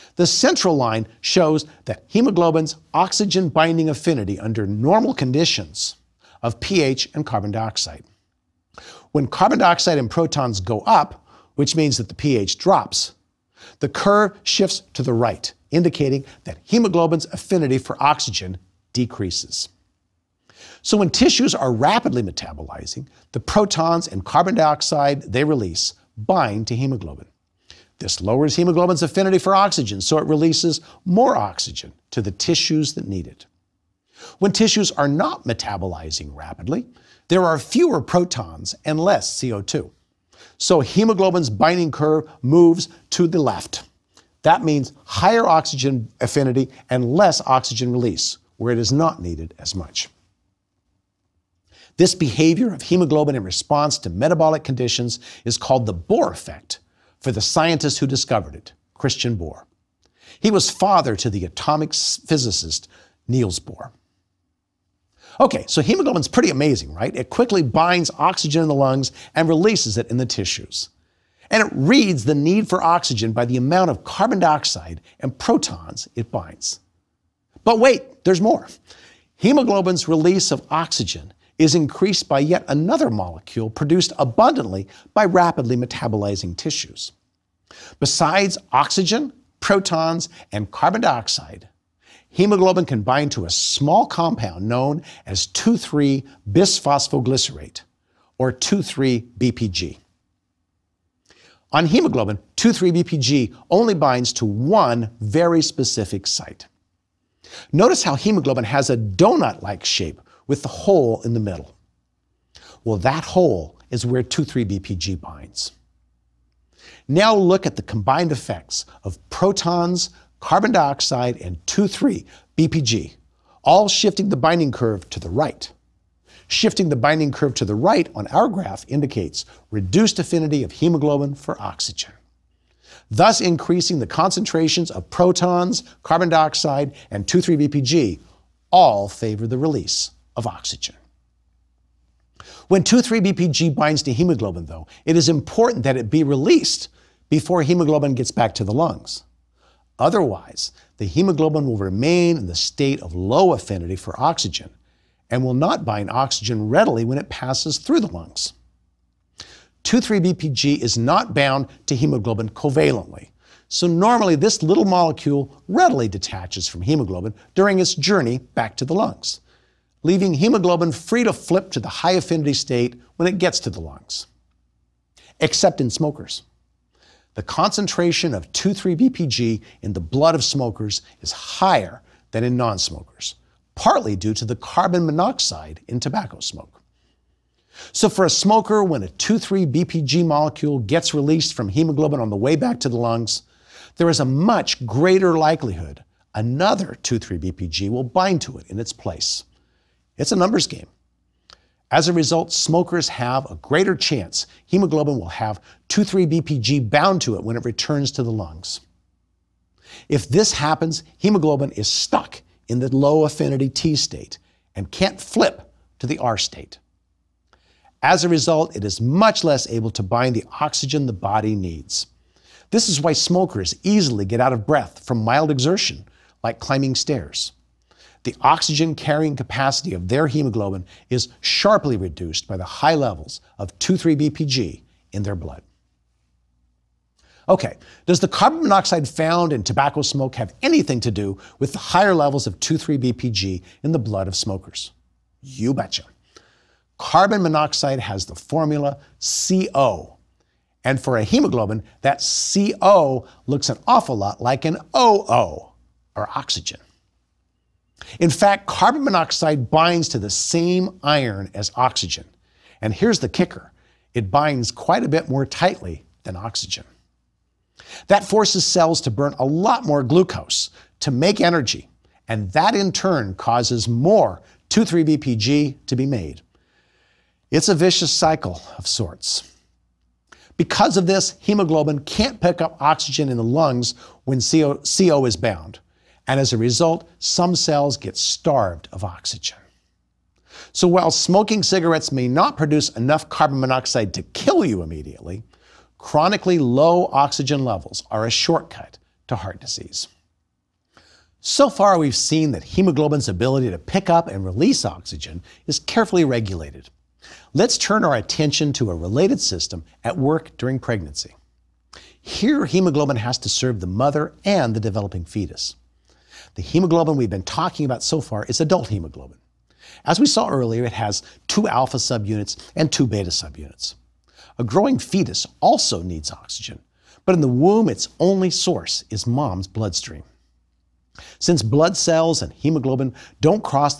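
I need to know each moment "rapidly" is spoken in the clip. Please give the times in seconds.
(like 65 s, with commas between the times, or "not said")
21 s, 36 s, 85 s.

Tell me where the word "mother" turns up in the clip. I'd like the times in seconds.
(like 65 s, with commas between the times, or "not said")
313 s.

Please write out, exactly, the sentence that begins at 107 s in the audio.
Notice how hemoglobin has a donut like shape with the hole in the middle.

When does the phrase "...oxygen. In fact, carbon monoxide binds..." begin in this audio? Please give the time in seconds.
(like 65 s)
256 s.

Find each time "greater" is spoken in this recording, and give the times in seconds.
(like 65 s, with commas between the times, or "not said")
194 s, 203 s.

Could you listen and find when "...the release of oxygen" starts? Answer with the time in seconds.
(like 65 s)
139 s.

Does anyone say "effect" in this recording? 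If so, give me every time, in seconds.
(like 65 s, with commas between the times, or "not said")
56 s, 118 s.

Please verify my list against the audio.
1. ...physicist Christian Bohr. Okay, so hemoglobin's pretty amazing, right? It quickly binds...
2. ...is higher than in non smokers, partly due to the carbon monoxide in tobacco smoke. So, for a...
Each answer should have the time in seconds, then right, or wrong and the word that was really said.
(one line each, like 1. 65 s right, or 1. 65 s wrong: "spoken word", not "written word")
1. 61 s wrong: "Niels", not "Christian"
2. 181 s right.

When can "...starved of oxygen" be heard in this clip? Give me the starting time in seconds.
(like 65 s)
288 s.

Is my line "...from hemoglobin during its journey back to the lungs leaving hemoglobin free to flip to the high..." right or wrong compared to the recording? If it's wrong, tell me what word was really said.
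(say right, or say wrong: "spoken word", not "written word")
right.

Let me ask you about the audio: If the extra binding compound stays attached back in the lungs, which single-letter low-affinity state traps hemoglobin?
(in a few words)
T state.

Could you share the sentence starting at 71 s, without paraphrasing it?
And it reads the need for oxygen by the amount of carbon dioxide and protons it binds.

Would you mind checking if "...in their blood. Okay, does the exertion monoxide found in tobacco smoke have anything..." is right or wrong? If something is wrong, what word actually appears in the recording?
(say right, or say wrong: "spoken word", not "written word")
wrong: "carbon", not "exertion".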